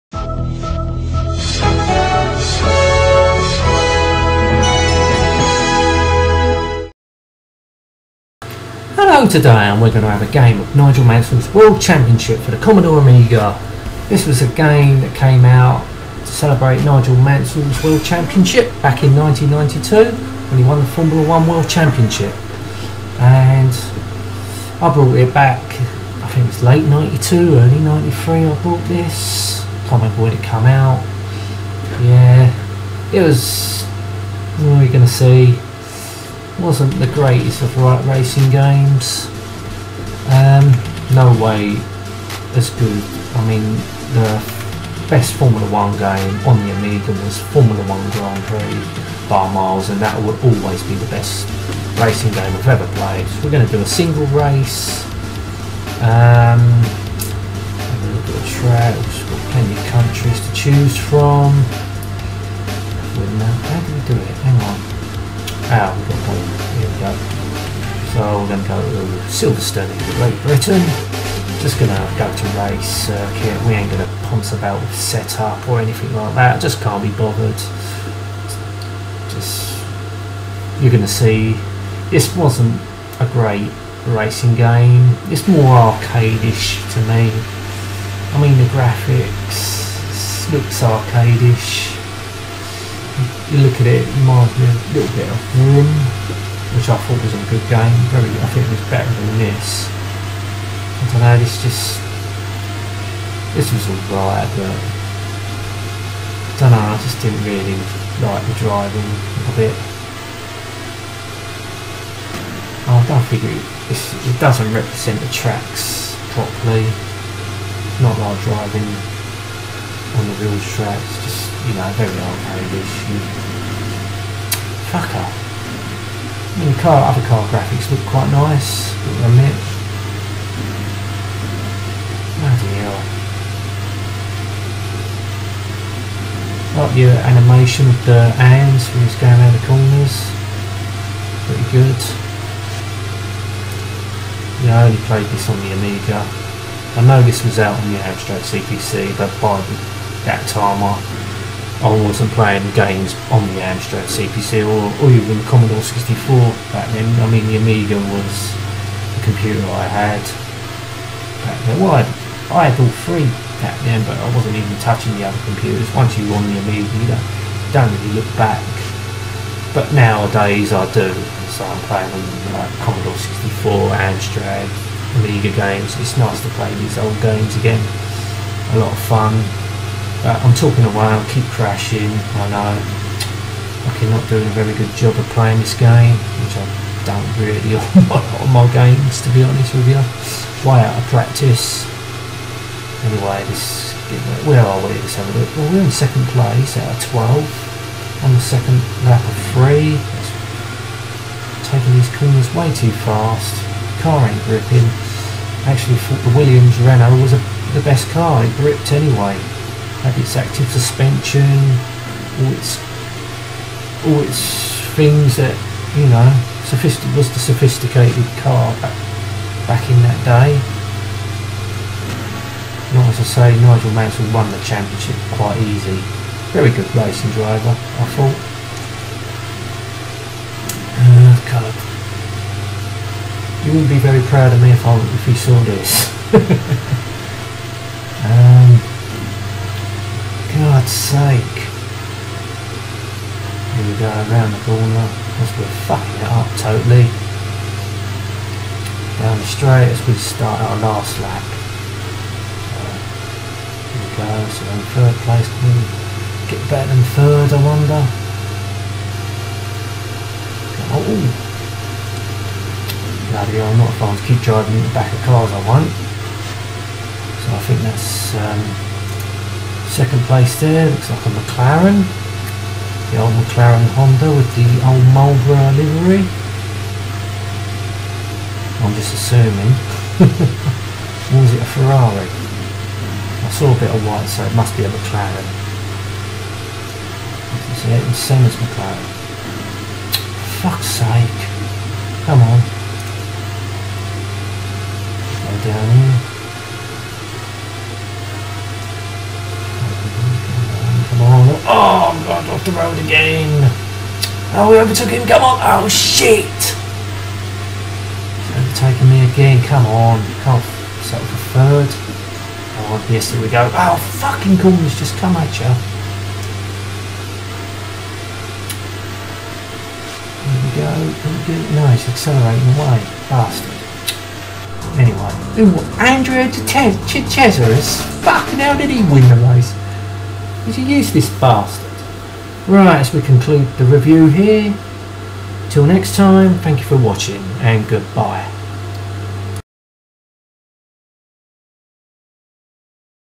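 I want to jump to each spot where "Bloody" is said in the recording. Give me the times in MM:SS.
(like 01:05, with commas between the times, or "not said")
02:12, 04:23.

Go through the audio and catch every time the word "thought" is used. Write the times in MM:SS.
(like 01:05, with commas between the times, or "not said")
01:36, 03:26, 03:48.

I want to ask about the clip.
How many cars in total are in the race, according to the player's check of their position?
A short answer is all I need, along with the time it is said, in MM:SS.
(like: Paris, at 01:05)
12, at 03:18.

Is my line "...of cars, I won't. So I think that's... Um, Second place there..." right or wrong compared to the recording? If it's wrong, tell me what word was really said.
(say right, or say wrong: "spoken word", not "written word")
right.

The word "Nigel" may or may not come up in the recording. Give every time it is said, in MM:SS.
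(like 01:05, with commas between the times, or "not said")
00:10, 00:16, 03:43.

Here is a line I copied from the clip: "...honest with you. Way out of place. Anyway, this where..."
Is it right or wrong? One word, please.
wrong.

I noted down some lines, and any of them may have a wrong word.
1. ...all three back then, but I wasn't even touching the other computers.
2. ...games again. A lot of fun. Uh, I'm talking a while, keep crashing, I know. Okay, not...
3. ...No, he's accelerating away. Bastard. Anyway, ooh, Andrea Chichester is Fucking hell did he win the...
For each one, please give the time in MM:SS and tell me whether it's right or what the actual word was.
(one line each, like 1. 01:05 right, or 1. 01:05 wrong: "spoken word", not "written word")
1. 02:42 right
2. 02:57 right
3. 05:21 right.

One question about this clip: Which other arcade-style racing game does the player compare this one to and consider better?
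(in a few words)
Vroom.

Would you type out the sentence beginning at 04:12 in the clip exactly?
Uh, here we go, so in third place, can hmm, we get better than third, I wonder?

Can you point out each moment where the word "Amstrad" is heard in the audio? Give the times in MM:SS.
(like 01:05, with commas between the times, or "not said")
02:27, 02:33, 02:54.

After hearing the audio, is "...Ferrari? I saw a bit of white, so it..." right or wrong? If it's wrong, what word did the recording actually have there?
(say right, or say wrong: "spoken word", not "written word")
right.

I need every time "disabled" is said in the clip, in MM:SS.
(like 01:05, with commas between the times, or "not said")
not said.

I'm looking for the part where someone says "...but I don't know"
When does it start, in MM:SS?
01:44.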